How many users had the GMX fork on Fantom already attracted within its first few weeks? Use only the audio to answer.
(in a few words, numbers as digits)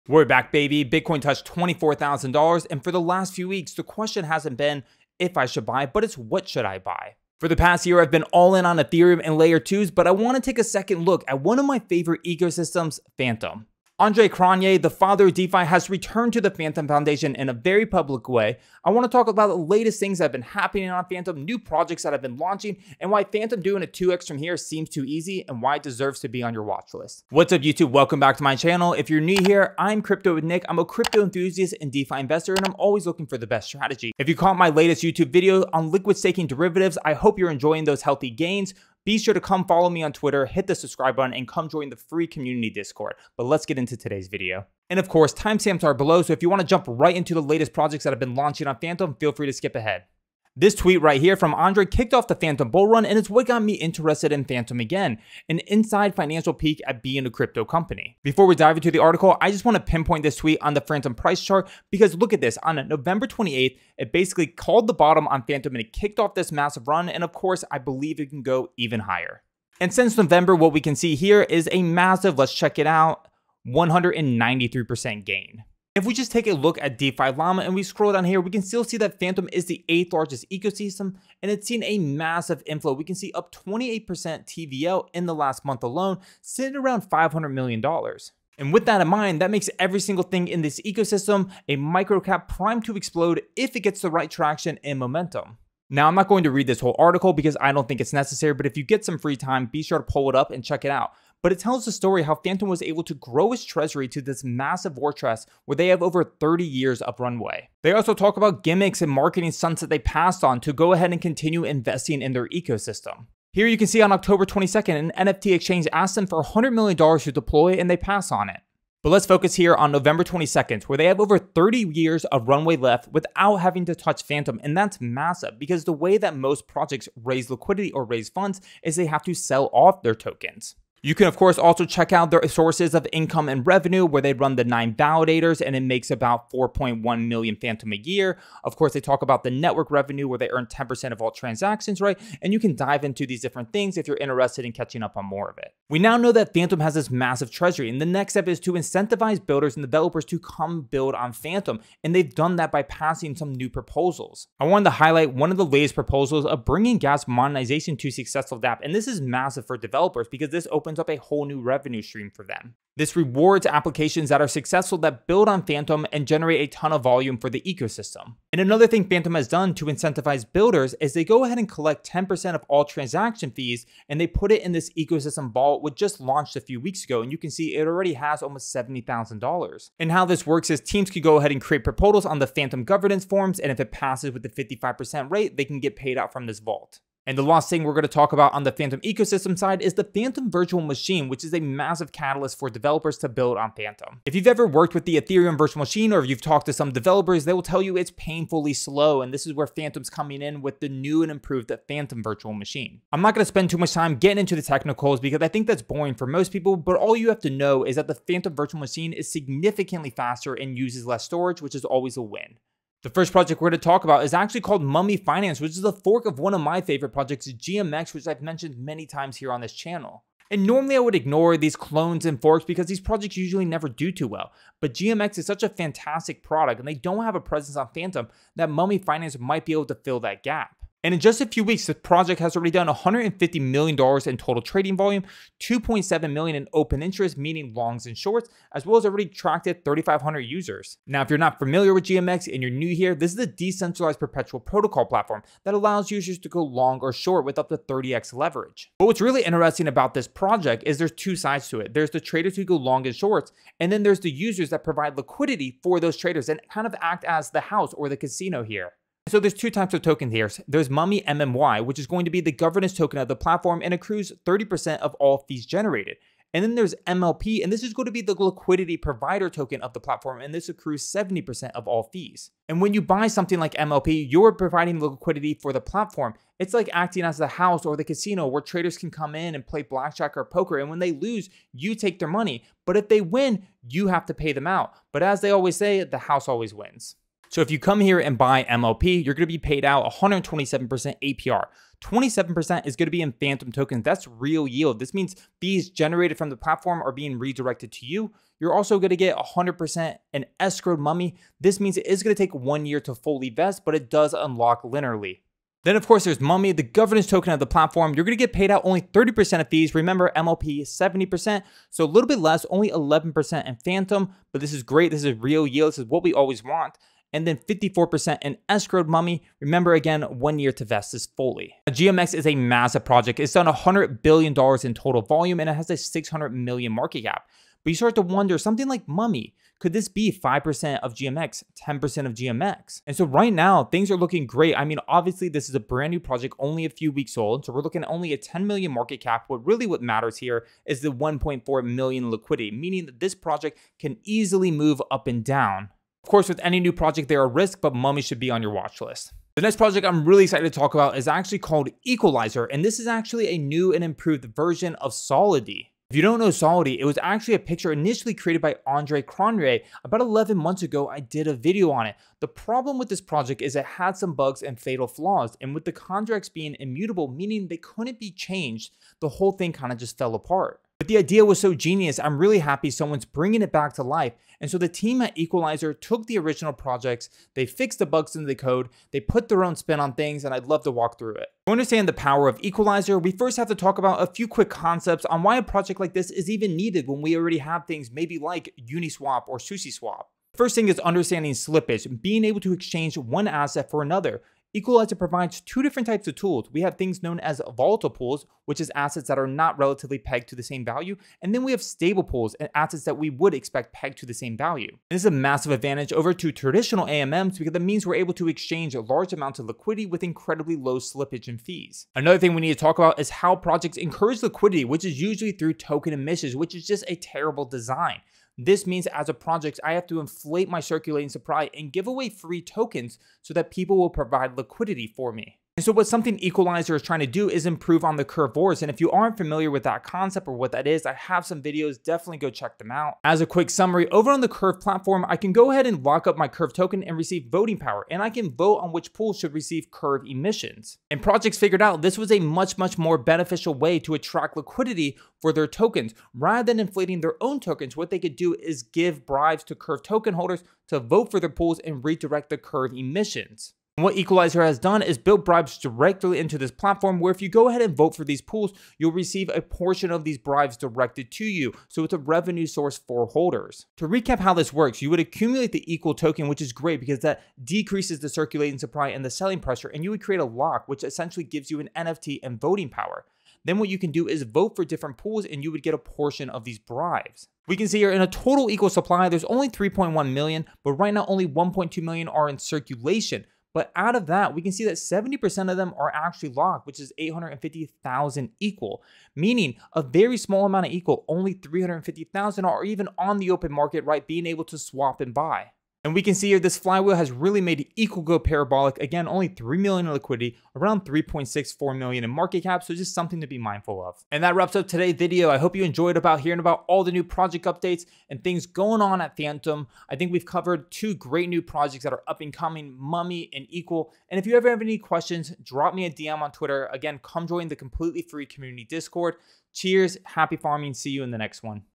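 3,500.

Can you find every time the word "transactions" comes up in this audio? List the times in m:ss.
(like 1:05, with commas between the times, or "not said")
2:21, 2:52.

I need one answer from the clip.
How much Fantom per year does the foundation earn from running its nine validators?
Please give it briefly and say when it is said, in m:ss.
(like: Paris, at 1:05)
4.1 million, at 2:16.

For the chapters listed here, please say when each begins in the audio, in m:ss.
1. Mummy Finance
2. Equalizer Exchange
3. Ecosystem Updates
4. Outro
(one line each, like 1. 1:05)
1. 3:32
2. 5:48
3. 0:51
4. 8:23.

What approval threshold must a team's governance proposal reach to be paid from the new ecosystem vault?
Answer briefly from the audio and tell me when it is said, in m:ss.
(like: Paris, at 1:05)
55%, at 3:04.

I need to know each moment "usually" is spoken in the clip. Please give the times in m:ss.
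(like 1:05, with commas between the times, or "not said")
3:43, 6:55.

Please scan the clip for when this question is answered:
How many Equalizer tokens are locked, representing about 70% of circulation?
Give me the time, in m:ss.
8:07.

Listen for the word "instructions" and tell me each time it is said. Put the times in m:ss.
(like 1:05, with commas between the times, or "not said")
not said.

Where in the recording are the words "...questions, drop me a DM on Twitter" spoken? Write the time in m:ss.
8:34.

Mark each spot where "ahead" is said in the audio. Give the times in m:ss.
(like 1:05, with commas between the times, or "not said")
0:49, 1:50, 2:51, 3:01, 7:15, 7:37.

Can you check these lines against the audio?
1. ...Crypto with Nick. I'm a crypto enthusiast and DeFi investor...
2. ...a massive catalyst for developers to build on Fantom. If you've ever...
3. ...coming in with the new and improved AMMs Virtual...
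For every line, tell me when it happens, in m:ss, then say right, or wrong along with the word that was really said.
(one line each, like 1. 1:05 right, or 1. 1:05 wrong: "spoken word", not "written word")
1. 0:30 right
2. 3:11 right
3. 3:20 wrong: "Fantom", not "AMMs".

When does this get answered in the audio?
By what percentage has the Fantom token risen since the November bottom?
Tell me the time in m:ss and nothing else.
1:13.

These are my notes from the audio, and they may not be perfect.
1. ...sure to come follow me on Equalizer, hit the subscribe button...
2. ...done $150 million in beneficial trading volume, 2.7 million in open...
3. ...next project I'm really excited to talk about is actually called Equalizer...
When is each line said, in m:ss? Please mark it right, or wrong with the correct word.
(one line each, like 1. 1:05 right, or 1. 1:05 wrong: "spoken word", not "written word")
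1. 0:39 wrong: "Twitter", not "Equalizer"
2. 3:52 wrong: "total", not "beneficial"
3. 5:49 right.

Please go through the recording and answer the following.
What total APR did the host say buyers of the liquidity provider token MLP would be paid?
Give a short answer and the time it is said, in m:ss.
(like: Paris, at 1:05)
127%, at 4:50.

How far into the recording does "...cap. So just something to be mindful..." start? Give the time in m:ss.
8:22.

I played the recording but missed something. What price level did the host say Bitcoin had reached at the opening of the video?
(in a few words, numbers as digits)
$24,000.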